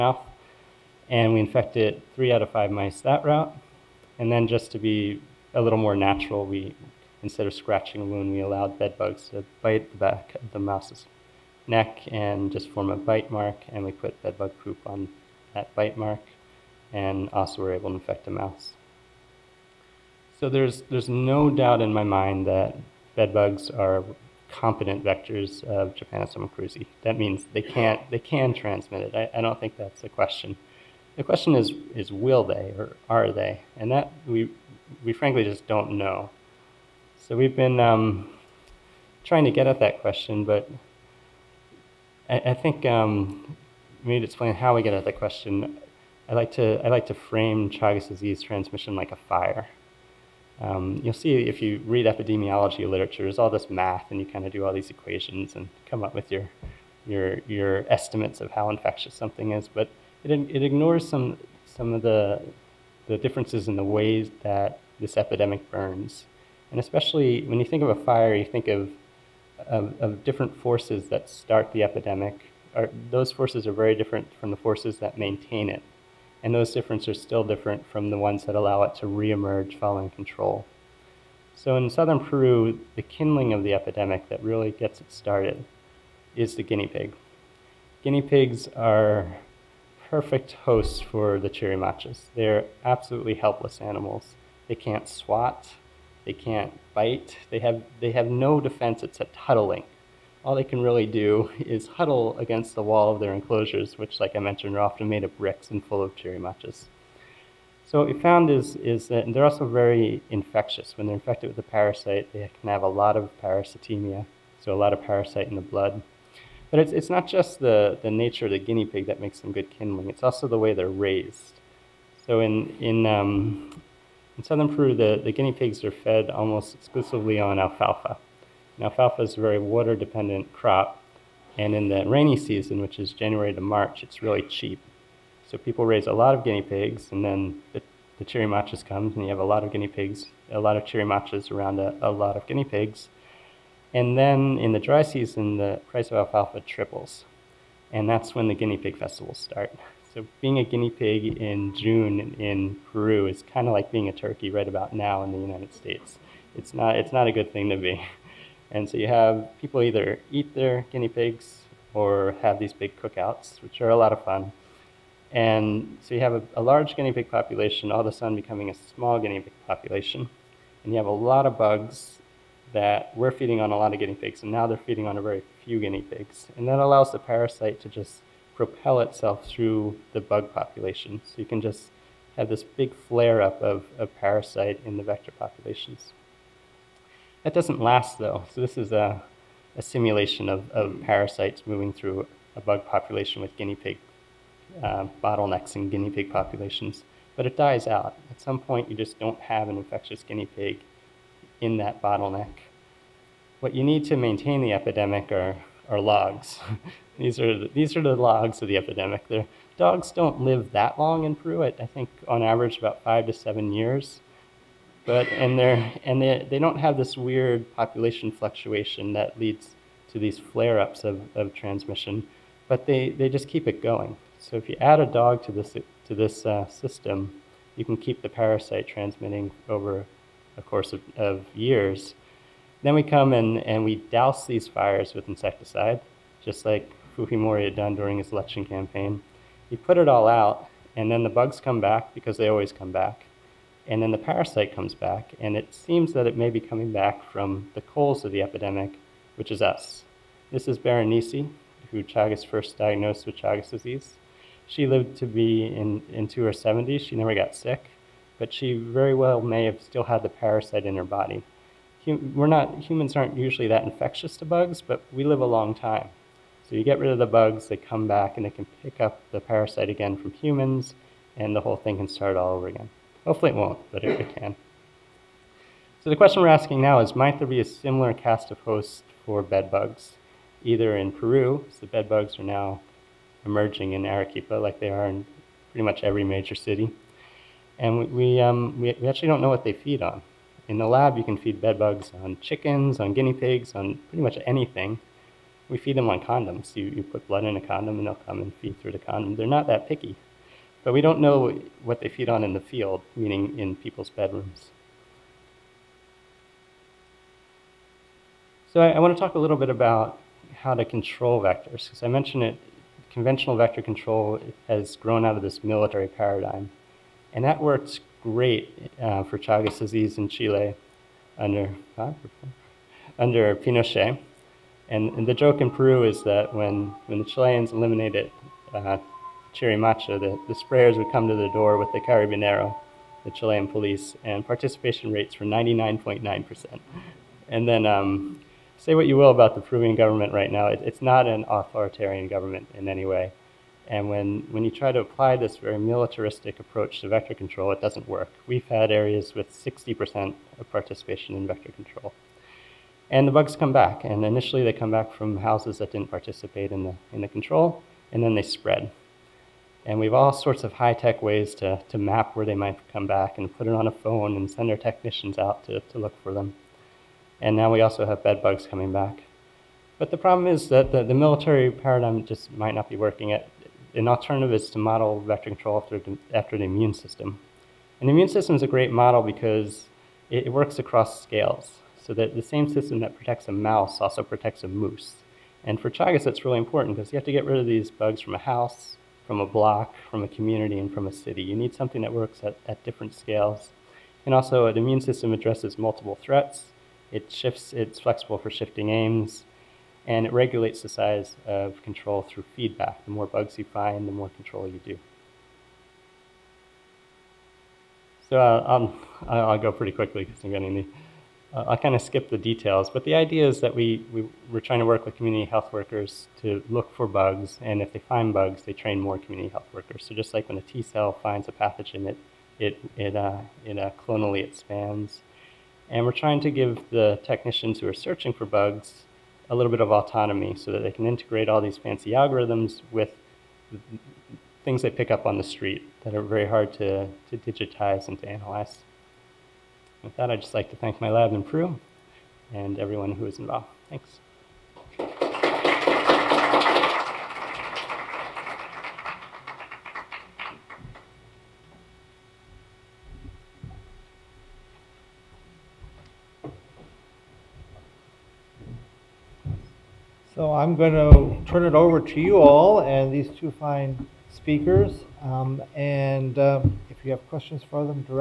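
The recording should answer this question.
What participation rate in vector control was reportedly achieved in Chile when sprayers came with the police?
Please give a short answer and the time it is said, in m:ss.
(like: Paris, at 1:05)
99.9%, at 5:35.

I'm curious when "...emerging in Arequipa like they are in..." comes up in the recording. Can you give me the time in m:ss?
4:43.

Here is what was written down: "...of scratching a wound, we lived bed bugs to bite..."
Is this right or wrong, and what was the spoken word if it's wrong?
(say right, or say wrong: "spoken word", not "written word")
wrong: "allowed", not "lived".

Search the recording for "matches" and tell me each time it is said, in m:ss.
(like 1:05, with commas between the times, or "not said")
1:46.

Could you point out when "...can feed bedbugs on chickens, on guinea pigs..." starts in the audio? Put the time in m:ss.
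4:51.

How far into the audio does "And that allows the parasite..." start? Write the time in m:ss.
2:56.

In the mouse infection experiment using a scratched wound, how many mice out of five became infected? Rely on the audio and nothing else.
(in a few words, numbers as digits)
3.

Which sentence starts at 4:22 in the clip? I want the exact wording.
Hum, we're not, humans aren't usually that infectious to bugs, but we live a long time.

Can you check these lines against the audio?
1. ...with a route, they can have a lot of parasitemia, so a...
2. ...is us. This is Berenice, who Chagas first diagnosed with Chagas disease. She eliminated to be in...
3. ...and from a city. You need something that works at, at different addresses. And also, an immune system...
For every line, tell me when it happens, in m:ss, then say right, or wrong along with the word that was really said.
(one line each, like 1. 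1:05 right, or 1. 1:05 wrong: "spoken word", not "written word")
1. 1:51 wrong: "parasite", not "route"
2. 4:09 wrong: "lived", not "eliminated"
3. 6:30 wrong: "scales", not "addresses".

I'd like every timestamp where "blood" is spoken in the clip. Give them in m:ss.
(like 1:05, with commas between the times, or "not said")
1:55, 4:57.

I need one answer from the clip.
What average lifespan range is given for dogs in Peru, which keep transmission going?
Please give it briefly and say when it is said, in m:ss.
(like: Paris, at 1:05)
5 to 7 years, at 3:33.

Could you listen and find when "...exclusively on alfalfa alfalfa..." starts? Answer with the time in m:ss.
2:06.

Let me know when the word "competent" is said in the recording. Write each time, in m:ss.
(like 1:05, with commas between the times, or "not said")
0:24.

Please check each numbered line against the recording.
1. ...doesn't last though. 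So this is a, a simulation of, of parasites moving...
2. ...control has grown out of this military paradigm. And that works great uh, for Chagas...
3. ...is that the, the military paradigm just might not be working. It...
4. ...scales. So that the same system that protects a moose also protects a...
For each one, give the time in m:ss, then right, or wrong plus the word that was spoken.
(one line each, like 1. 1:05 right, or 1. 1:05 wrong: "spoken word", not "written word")
1. 3:07 right
2. 5:13 right
3. 6:10 right
4. 6:21 wrong: "mouse", not "moose".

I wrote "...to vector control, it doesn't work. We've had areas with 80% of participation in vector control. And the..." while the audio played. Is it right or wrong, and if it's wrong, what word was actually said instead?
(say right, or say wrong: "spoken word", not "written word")
wrong: "60", not "80".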